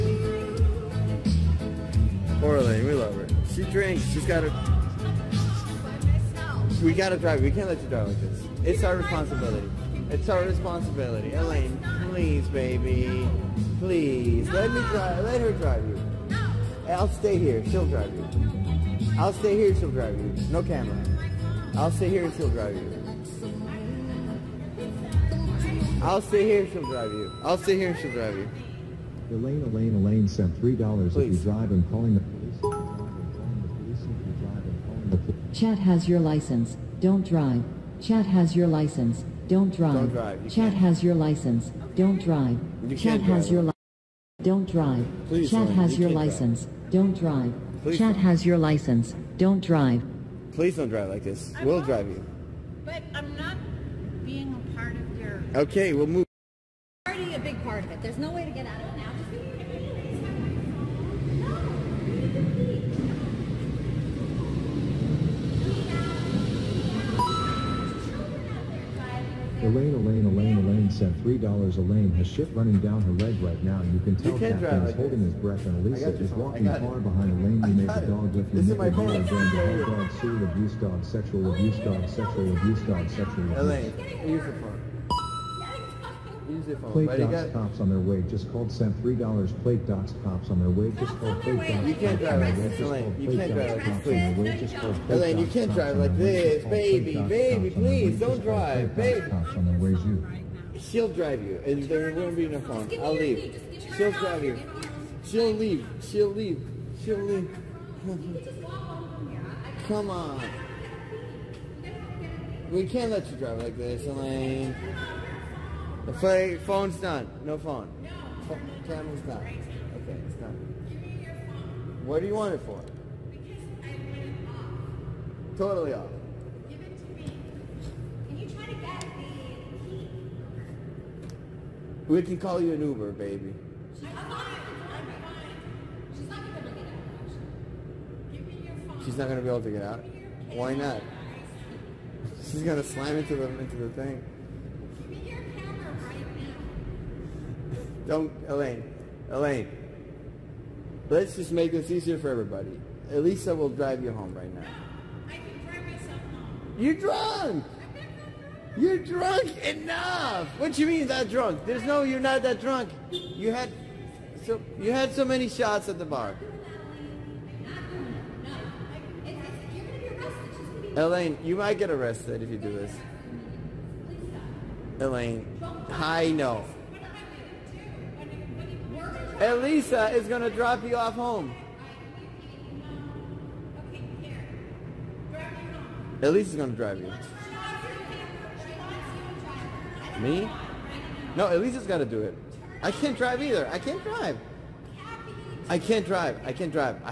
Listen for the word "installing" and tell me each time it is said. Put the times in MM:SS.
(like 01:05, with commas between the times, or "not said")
not said.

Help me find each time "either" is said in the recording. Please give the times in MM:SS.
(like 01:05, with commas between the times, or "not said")
03:13.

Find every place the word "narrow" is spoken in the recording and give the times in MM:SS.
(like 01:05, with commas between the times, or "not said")
not said.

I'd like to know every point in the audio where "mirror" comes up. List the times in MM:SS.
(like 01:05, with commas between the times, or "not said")
not said.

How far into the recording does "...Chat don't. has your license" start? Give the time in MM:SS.
00:47.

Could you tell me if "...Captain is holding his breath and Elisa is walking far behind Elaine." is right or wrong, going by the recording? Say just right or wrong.
right.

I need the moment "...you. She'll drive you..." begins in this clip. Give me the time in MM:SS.
01:39.